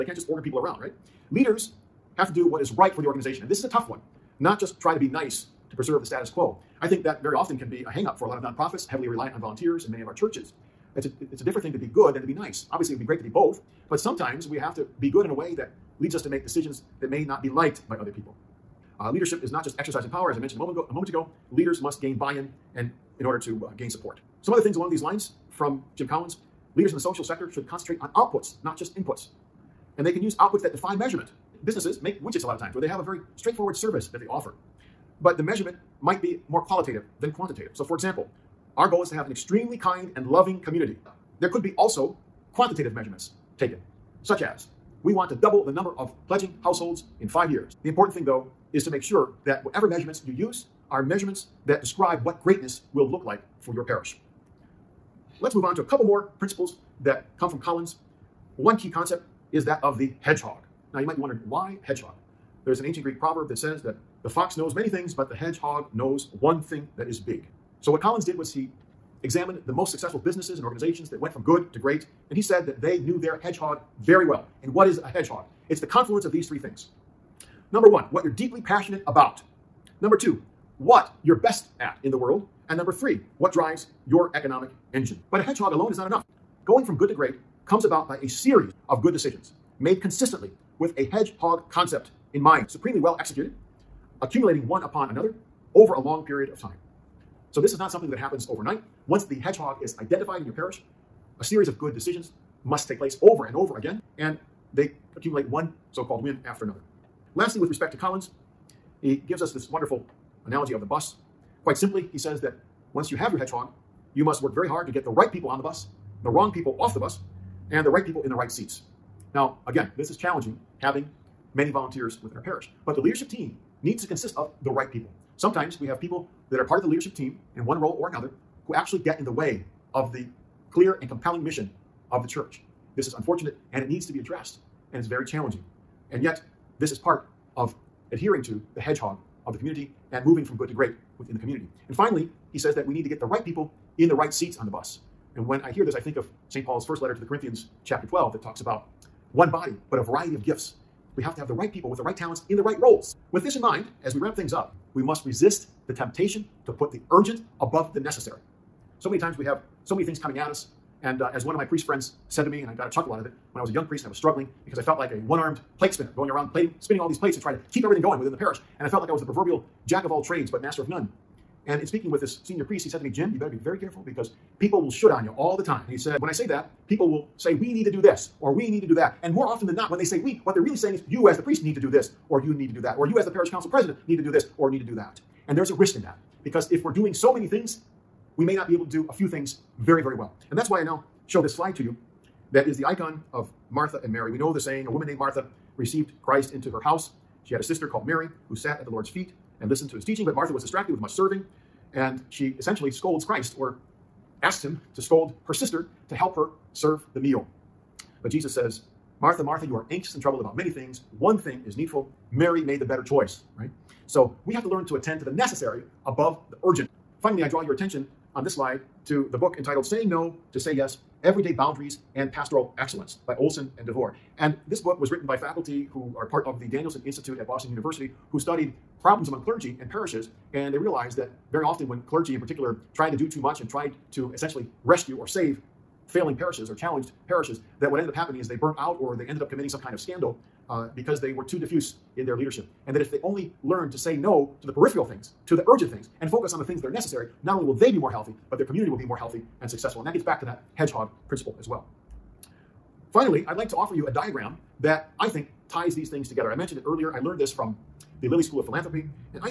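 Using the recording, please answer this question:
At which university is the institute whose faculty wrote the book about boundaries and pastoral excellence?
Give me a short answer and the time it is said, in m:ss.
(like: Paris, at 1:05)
Boston University, at 3:47.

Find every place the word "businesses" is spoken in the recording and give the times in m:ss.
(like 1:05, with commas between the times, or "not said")
0:31, 1:10.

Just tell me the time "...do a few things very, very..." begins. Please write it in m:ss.
3:08.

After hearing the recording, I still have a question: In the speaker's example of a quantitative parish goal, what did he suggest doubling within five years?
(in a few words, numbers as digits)
pledging households.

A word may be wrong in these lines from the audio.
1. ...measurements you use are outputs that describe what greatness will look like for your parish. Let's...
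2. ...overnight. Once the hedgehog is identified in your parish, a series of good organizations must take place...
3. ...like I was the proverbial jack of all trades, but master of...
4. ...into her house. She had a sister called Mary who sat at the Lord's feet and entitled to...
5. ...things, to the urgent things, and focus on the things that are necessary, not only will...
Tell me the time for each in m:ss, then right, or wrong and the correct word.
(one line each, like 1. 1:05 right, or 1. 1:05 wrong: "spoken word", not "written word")
1. 0:49 wrong: "measurements", not "outputs"
2. 1:38 wrong: "decisions", not "organizations"
3. 2:49 right
4. 3:16 wrong: "listened", not "entitled"
5. 4:05 right.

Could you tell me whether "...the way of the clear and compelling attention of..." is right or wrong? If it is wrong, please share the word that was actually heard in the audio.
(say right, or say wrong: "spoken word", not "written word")
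wrong: "mission", not "attention".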